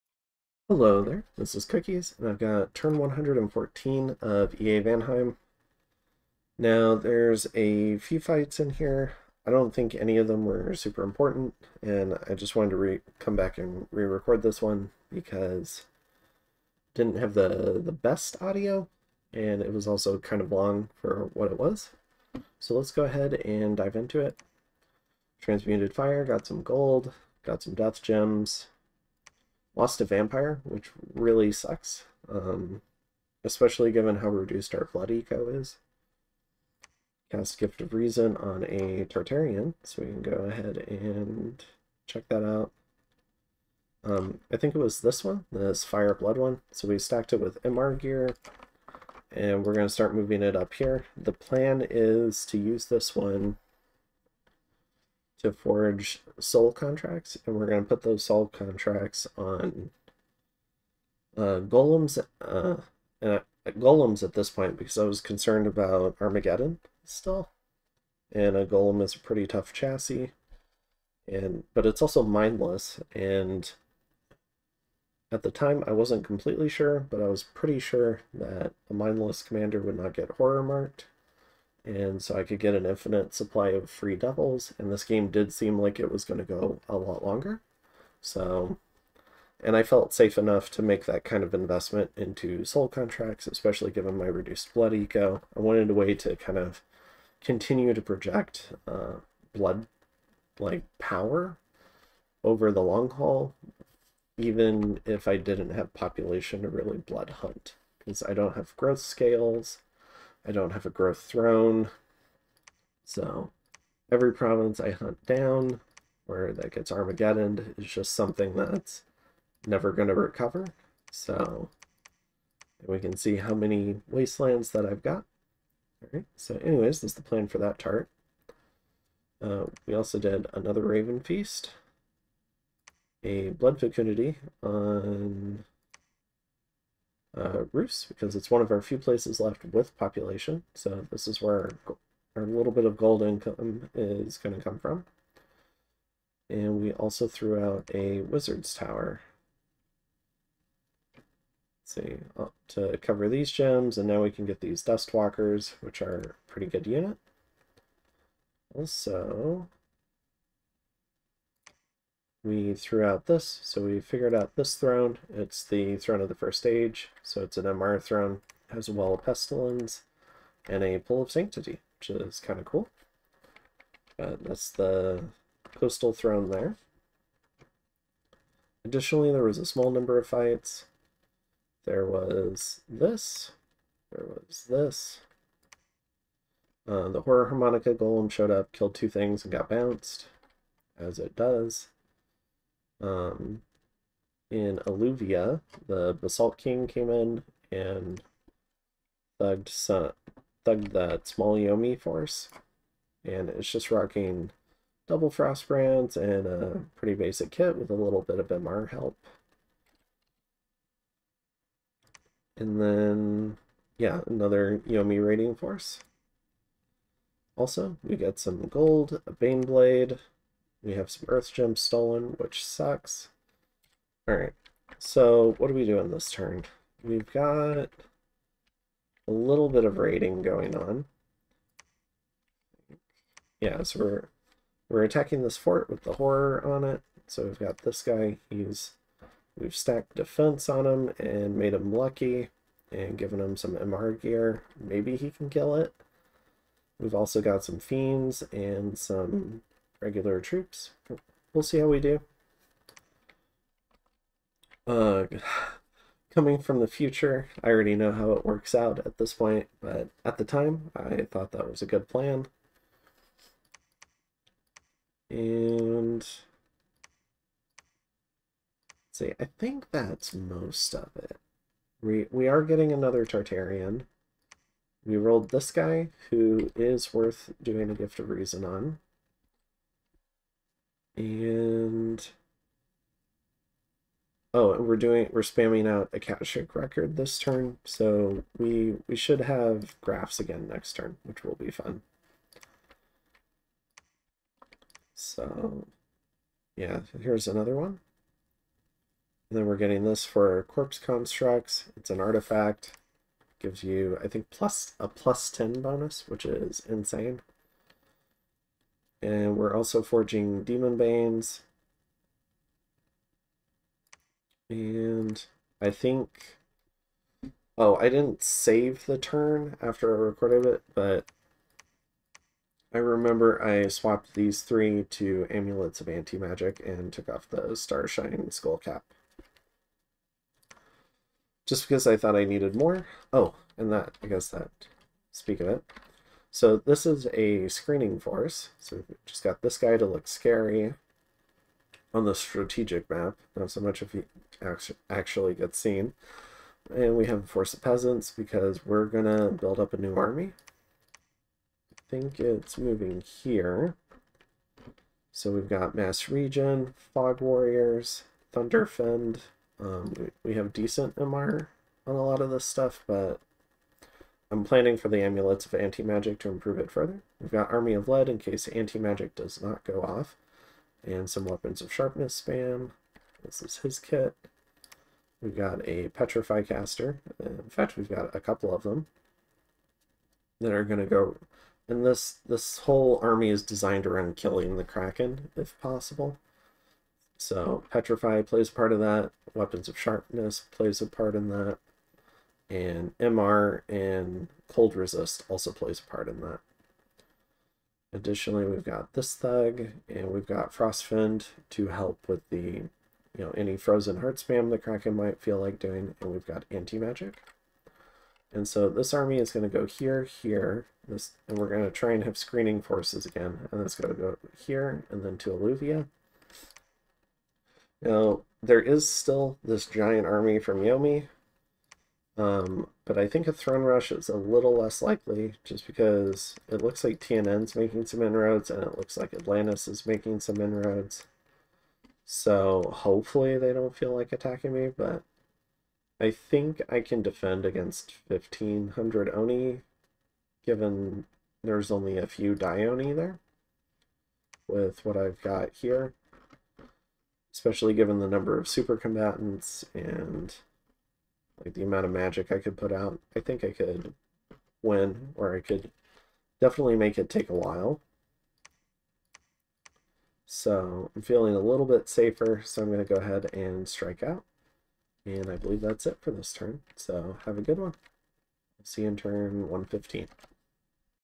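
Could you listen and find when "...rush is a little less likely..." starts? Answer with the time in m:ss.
7:03.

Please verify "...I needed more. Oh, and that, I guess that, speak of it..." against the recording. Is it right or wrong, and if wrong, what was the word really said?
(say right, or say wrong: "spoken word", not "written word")
right.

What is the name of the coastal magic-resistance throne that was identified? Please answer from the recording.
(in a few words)
Throne of the First Age.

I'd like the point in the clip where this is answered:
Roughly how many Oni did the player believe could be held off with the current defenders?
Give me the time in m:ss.
7:18.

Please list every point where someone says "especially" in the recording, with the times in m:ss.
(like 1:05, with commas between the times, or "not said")
0:33, 1:33, 7:27.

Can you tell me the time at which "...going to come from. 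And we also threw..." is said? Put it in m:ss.
2:24.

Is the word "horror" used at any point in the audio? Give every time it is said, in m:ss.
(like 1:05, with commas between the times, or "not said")
1:20, 3:07, 3:56.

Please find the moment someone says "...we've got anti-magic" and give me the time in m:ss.
6:46.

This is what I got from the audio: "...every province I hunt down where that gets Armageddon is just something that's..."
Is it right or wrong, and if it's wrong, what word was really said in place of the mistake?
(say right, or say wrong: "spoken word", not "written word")
right.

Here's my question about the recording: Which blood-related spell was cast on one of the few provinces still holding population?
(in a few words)
Blood Fecundity.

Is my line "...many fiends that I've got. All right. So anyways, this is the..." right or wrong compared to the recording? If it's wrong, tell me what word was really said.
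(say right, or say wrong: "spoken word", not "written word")
wrong: "wastelands", not "fiends".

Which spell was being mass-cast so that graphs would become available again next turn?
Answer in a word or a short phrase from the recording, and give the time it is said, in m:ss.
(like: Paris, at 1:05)
Akashic Record, at 4:46.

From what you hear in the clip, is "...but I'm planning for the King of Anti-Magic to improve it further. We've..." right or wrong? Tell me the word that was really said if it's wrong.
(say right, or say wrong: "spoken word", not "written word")
wrong: "Amulets", not "King".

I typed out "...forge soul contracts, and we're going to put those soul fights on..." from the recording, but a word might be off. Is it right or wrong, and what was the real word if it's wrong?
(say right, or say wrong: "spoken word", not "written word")
wrong: "contracts", not "fights".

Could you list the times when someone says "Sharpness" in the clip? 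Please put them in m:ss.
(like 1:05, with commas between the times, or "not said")
6:11, 6:29.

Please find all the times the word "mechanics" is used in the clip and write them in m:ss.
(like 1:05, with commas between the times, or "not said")
not said.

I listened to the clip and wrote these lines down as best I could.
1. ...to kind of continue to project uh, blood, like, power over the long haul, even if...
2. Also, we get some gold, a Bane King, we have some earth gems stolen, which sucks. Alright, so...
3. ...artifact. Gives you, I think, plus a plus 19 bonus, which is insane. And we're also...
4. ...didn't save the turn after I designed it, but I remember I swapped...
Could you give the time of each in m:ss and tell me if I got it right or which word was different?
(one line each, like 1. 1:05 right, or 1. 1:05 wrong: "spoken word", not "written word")
1. 1:36 right
2. 3:37 wrong: "Blade", not "King"
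3. 5:02 wrong: "10", not "19"
4. 5:18 wrong: "recorded", not "designed".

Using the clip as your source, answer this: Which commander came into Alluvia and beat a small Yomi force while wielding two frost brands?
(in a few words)
Basalt King.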